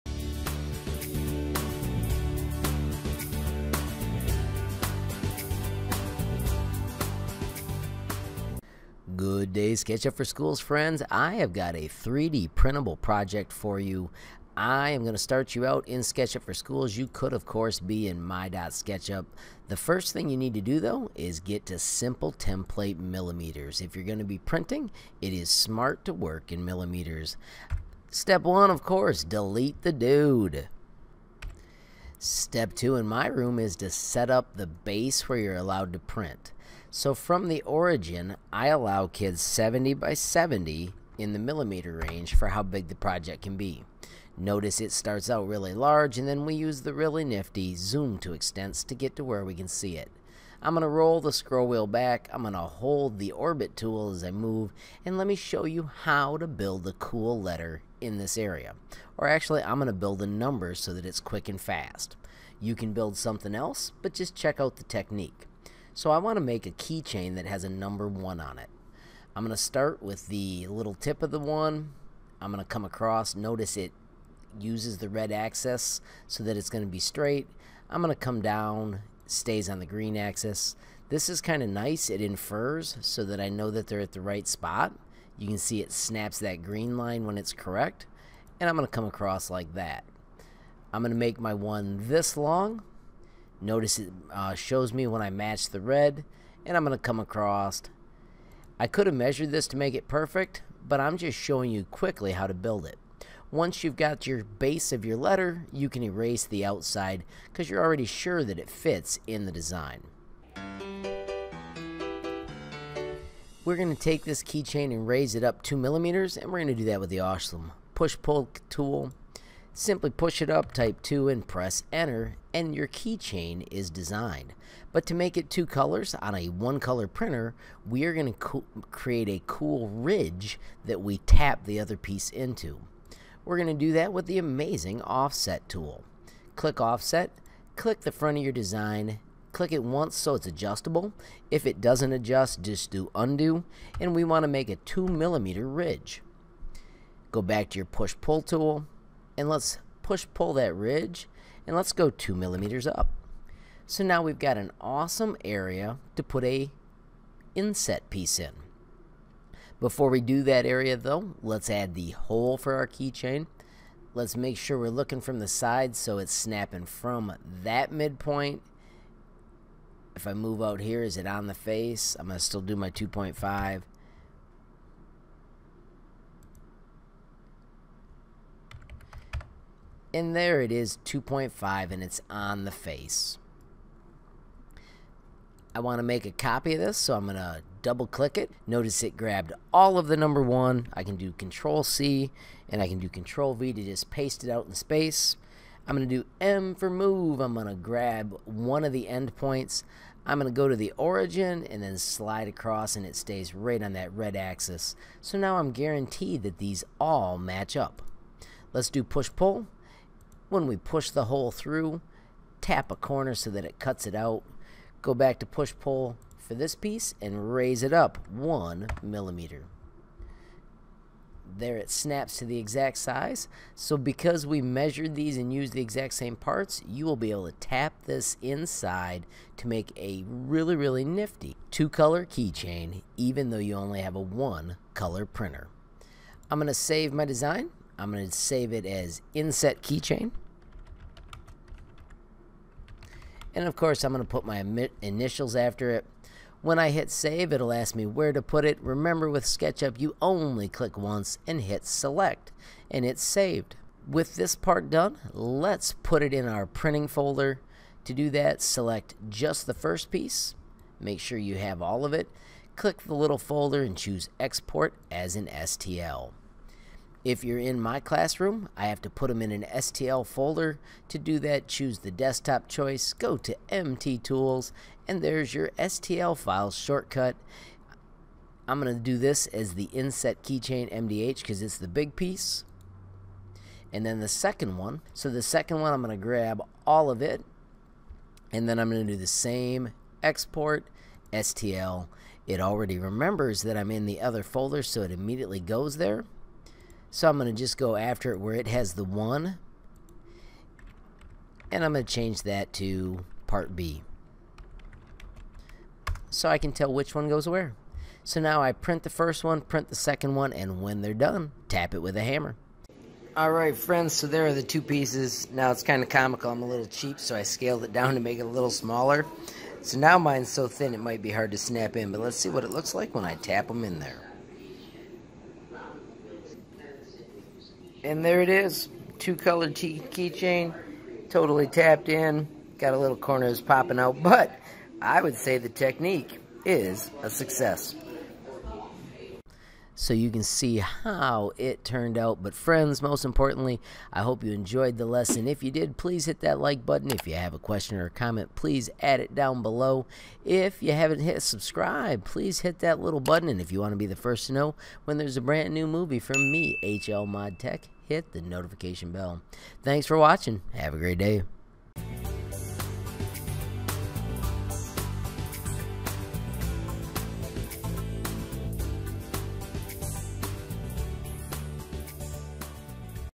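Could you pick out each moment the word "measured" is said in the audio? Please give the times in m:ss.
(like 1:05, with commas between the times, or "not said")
1:39, 3:44.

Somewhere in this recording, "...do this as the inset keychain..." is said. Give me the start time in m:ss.
4:39.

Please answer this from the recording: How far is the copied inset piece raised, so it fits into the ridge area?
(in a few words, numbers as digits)
1 millimeter.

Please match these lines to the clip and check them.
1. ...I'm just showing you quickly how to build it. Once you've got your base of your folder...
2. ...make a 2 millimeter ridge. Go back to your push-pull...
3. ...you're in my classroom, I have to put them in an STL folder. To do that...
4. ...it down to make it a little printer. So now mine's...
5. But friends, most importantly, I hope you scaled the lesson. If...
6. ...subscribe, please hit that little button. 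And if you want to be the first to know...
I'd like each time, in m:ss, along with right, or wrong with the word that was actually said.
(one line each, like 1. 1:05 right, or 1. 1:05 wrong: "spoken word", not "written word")
1. 1:40 wrong: "letter", not "folder"
2. 2:24 right
3. 4:27 right
4. 5:17 wrong: "smaller", not "printer"
5. 5:42 wrong: "enjoyed", not "scaled"
6. 5:51 right.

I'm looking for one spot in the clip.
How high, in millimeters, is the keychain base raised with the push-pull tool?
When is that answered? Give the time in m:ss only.
2:00.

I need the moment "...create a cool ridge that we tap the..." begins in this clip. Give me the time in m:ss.
2:08.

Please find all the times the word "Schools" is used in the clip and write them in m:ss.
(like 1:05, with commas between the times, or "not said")
0:10, 0:16.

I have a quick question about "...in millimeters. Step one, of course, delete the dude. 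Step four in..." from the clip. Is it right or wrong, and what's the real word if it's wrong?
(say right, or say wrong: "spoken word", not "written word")
wrong: "two", not "four".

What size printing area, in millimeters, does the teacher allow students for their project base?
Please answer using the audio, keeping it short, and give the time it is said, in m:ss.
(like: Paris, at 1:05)
70 by 70, at 0:39.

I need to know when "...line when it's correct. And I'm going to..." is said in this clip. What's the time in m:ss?
1:26.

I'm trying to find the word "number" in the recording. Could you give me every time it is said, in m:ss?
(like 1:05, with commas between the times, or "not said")
1:00, 1:07, 3:10.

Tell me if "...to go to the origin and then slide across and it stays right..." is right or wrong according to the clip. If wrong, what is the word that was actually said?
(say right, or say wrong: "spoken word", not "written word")
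right.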